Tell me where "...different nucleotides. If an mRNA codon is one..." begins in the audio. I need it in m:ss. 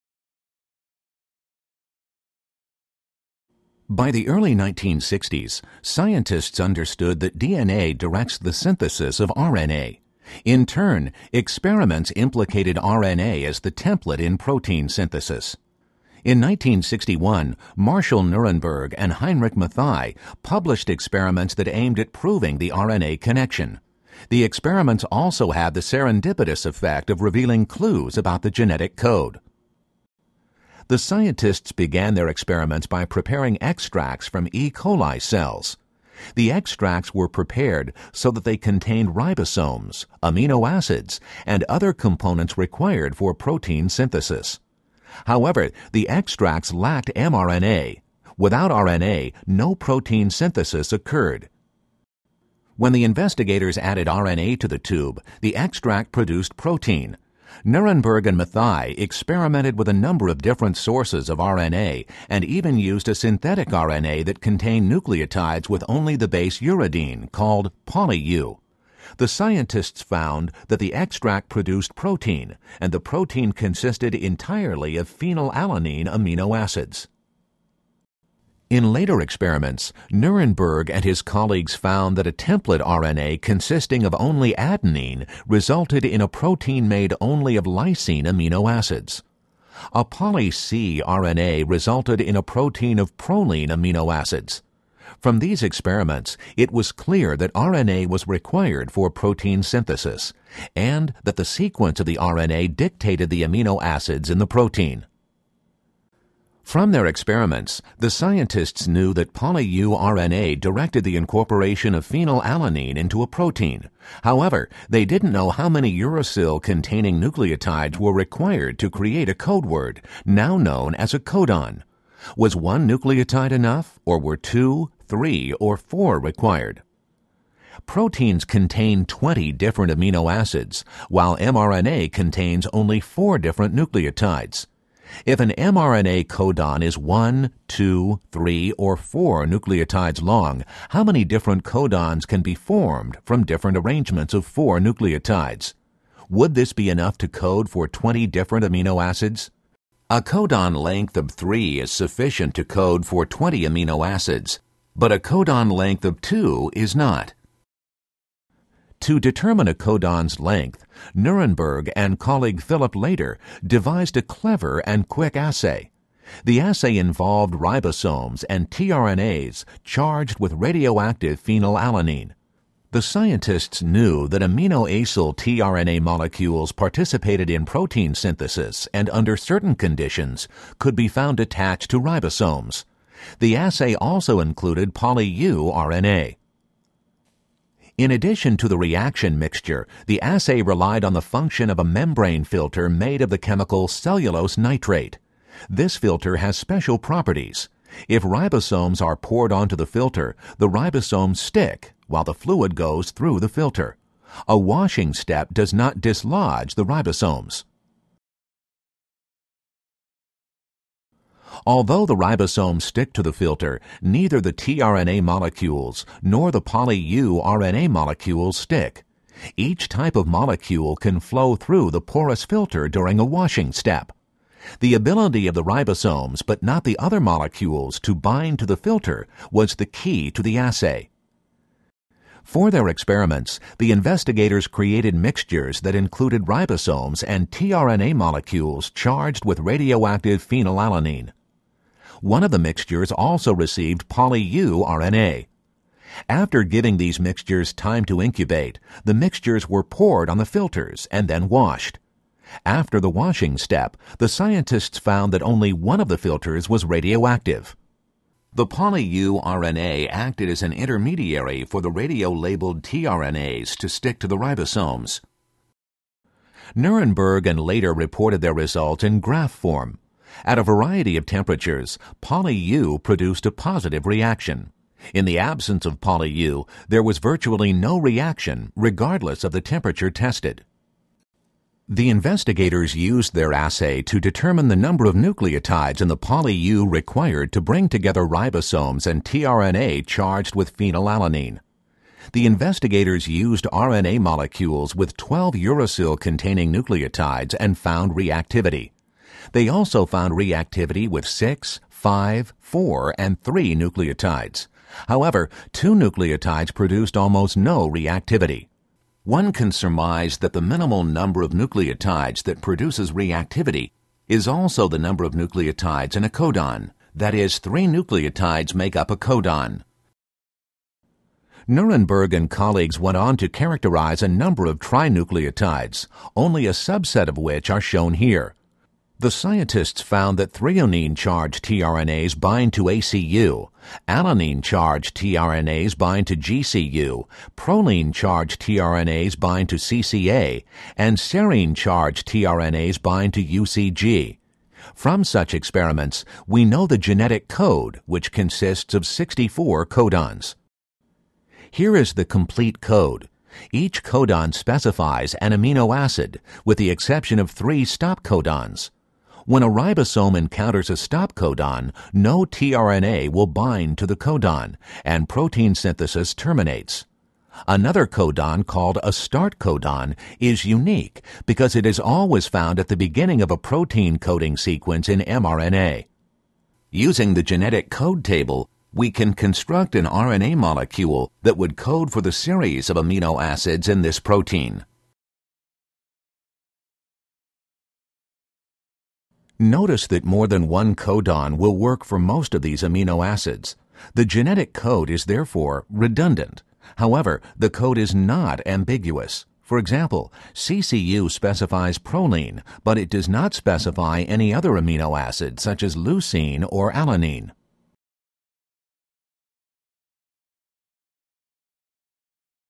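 2:13.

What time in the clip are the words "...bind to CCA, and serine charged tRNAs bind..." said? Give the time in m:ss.
5:39.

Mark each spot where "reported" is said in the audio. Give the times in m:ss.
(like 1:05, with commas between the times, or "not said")
4:27.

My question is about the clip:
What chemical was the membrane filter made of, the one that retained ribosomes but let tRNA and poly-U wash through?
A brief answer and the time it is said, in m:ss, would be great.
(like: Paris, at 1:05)
cellulose nitrate, at 3:13.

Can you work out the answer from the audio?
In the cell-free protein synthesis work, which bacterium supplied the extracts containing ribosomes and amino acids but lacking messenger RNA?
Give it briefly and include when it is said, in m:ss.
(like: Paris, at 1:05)
E. coli, at 0:34.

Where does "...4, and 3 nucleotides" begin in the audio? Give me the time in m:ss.
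5:02.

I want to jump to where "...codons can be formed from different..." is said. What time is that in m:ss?
2:21.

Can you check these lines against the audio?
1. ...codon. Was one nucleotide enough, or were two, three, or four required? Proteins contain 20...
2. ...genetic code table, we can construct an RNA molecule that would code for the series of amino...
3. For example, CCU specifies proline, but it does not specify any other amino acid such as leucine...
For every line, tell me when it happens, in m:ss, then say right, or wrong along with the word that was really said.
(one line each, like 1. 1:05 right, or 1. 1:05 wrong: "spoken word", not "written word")
1. 2:01 right
2. 6:17 right
3. 6:39 right.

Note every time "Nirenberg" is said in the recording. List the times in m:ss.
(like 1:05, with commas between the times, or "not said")
0:18, 0:57, 1:20, 2:41, 4:26, 5:21.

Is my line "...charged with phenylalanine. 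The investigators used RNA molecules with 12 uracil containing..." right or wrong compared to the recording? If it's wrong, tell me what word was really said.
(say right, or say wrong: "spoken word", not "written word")
right.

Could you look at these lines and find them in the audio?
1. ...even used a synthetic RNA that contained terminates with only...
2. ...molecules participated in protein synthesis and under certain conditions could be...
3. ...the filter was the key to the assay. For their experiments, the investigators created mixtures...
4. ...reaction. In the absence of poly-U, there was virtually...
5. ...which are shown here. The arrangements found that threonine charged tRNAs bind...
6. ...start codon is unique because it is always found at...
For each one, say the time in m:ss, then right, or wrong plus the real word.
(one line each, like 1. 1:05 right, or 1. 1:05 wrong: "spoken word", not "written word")
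1. 1:02 wrong: "nucleotides", not "terminates"
2. 2:55 right
3. 3:48 right
4. 4:34 right
5. 5:27 wrong: "scientists", not "arrangements"
6. 6:09 right.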